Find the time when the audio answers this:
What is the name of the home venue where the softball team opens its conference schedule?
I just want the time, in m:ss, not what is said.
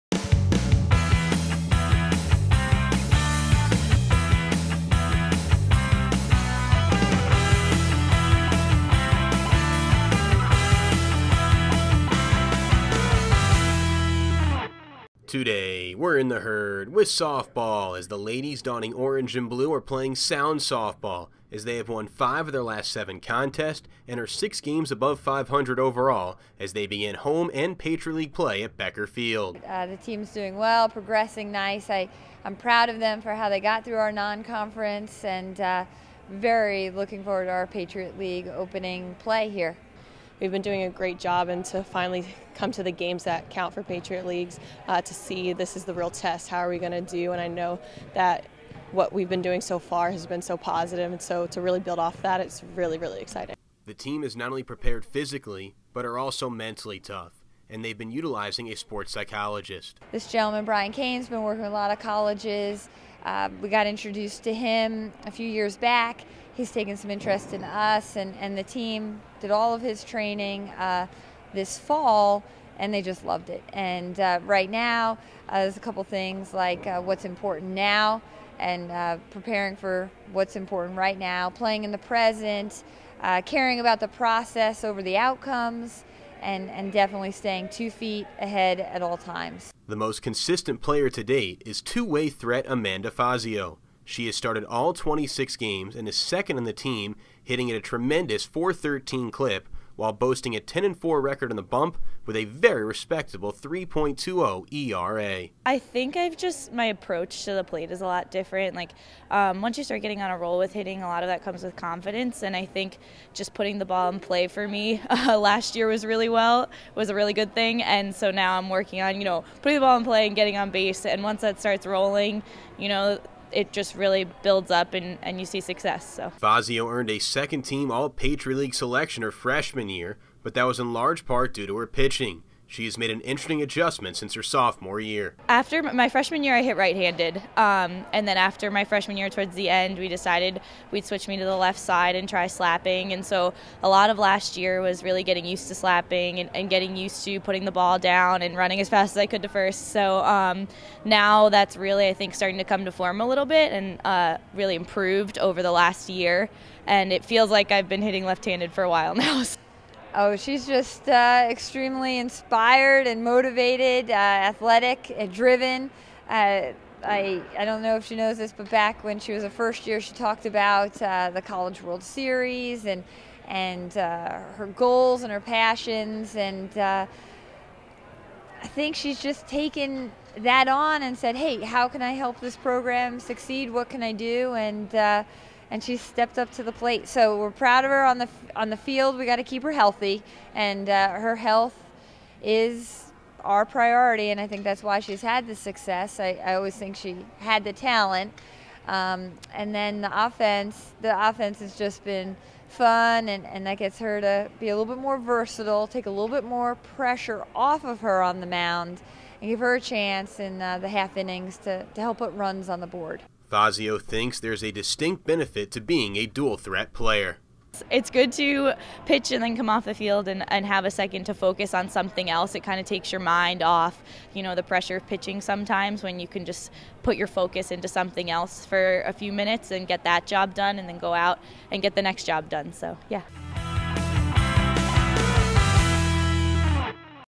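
0:28.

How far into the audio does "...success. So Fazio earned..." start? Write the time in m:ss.
2:05.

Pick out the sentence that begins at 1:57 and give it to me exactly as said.
And so now I'm working on, you know, putting the ball in play and getting on base.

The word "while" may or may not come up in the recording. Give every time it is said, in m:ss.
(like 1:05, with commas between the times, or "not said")
1:39, 2:38.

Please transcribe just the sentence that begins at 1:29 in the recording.
The most consistent player to date is two way threat Amanda Fazio.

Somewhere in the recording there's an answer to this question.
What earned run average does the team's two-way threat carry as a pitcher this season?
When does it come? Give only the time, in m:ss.
1:43.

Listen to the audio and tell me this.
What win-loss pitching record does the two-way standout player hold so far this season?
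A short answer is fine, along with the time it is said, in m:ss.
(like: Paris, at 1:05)
10-4, at 1:40.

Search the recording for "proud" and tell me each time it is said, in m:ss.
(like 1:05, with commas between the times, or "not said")
0:32, 3:07.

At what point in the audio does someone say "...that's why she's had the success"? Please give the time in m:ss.
3:14.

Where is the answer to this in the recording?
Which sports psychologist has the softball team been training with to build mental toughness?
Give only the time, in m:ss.
1:00.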